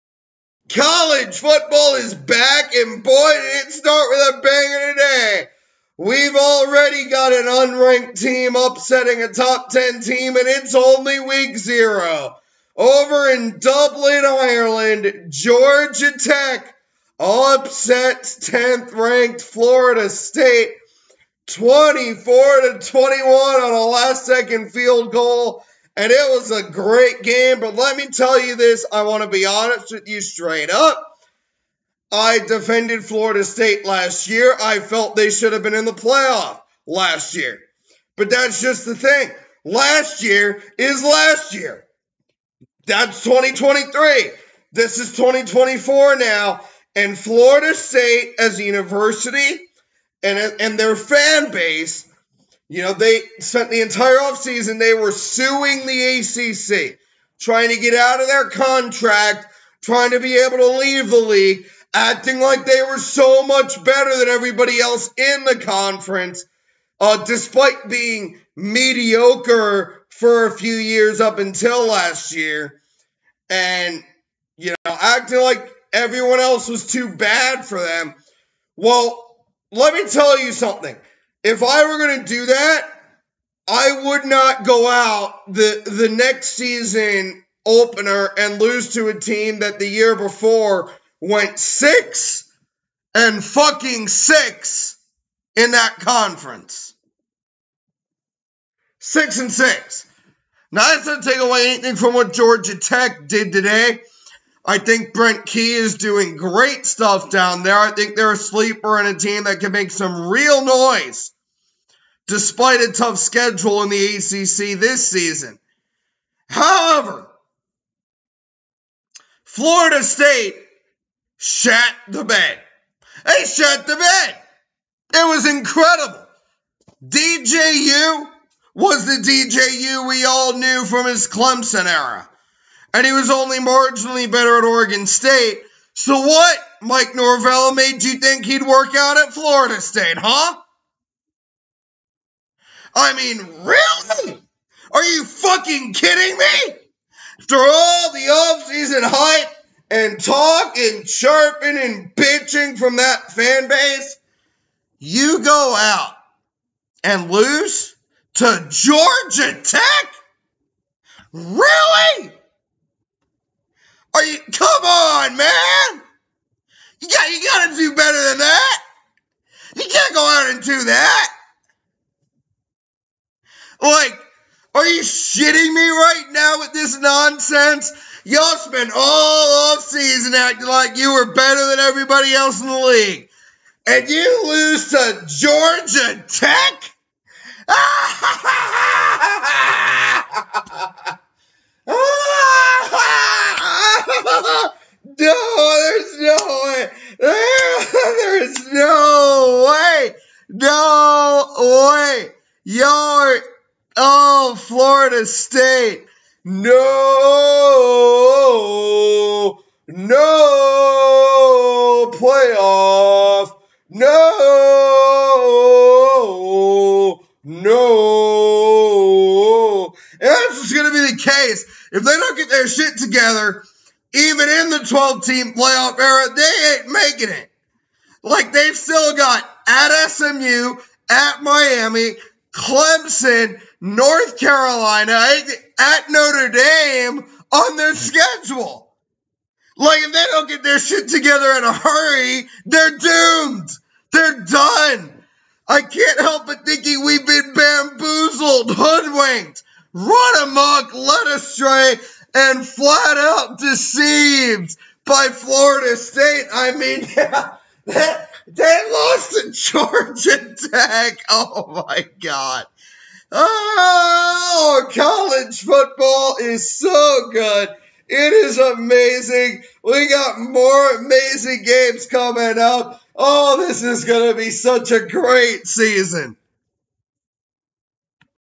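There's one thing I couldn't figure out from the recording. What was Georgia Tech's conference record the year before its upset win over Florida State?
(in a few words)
6 and 6.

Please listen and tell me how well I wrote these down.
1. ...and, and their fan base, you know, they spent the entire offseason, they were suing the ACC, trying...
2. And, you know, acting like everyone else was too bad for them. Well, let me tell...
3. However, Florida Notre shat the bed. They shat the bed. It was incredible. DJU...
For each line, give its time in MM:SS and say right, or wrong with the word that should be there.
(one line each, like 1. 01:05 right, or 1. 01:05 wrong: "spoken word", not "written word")
1. 00:50 right
2. 01:13 right
3. 01:56 wrong: "State", not "Notre".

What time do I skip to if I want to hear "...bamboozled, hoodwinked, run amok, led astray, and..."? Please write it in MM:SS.
04:07.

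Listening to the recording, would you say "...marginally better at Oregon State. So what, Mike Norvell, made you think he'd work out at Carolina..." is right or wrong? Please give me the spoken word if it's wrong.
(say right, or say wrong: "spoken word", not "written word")
wrong: "Florida", not "Carolina".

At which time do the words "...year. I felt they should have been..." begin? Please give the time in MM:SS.
00:34.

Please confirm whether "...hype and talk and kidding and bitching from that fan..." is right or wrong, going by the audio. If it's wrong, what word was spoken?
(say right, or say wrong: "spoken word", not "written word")
wrong: "chirping", not "kidding".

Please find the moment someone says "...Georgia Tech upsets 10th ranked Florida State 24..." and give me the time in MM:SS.
00:15.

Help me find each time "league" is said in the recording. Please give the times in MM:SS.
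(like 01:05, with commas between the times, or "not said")
01:01, 03:02.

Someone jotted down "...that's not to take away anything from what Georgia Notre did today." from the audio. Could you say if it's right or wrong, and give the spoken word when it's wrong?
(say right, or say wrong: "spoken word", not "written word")
wrong: "Tech", not "Notre".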